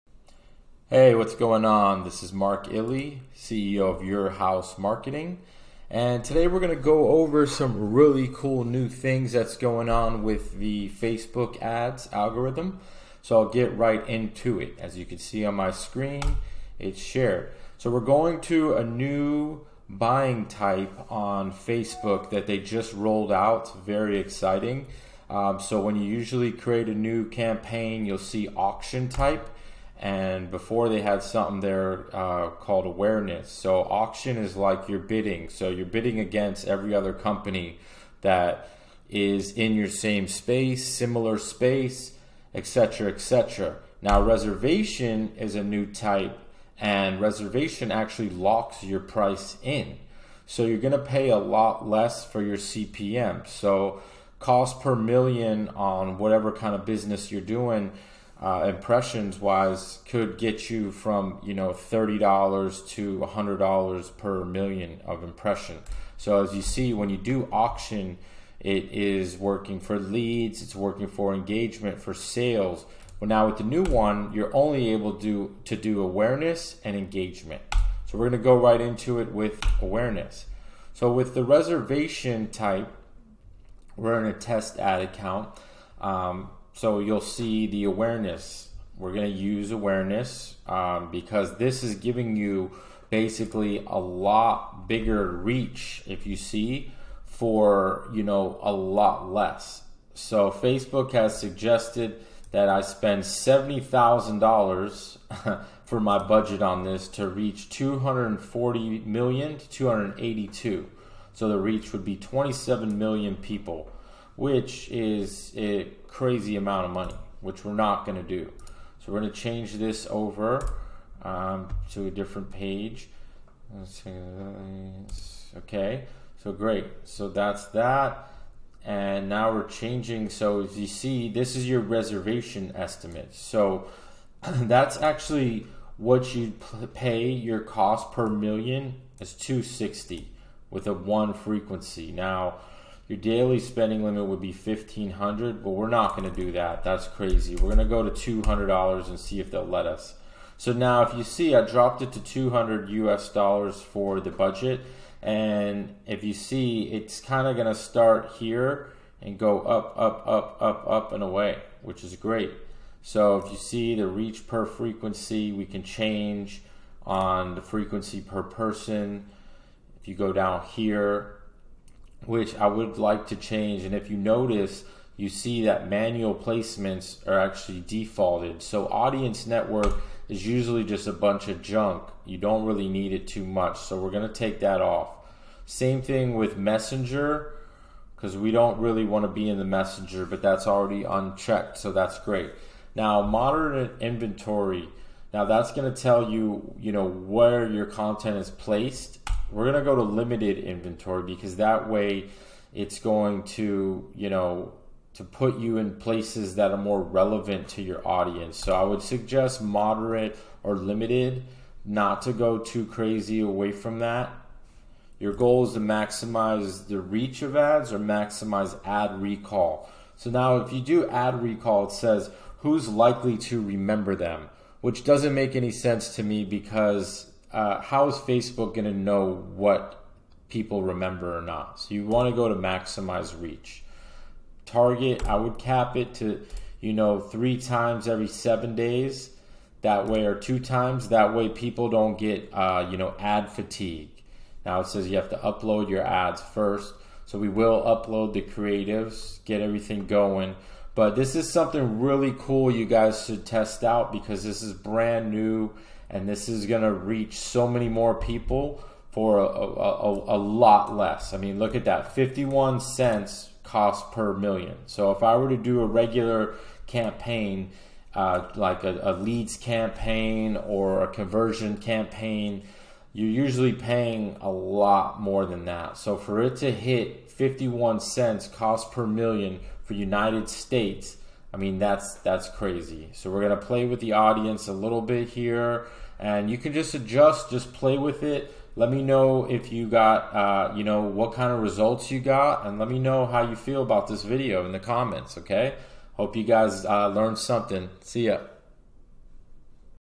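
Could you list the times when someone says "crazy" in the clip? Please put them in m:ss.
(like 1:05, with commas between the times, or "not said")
1:56, 2:27, 3:32, 4:42.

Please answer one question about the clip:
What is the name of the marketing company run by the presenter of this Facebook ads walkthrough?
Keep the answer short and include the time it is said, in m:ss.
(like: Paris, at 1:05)
Your House Marketing, at 0:04.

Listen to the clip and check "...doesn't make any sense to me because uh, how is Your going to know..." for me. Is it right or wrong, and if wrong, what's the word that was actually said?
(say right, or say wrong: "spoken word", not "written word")
wrong: "Facebook", not "Your".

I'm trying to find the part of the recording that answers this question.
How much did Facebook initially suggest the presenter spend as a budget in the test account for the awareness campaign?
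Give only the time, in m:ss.
1:43.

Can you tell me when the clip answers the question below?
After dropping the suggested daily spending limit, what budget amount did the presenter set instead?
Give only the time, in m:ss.
2:32.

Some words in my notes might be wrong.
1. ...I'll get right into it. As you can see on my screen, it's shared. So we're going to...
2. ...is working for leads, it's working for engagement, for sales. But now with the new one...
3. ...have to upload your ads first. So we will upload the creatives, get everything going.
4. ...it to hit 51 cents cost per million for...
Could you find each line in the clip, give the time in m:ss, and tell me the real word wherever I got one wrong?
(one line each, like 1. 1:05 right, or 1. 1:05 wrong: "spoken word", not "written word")
1. 0:13 right
2. 1:08 right
3. 4:05 right
4. 4:36 right.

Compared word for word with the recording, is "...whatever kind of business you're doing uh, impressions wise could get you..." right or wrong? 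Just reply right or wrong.
right.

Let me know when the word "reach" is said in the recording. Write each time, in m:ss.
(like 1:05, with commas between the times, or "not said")
1:35, 1:47, 1:51, 2:44, 3:37, 3:53, 4:16.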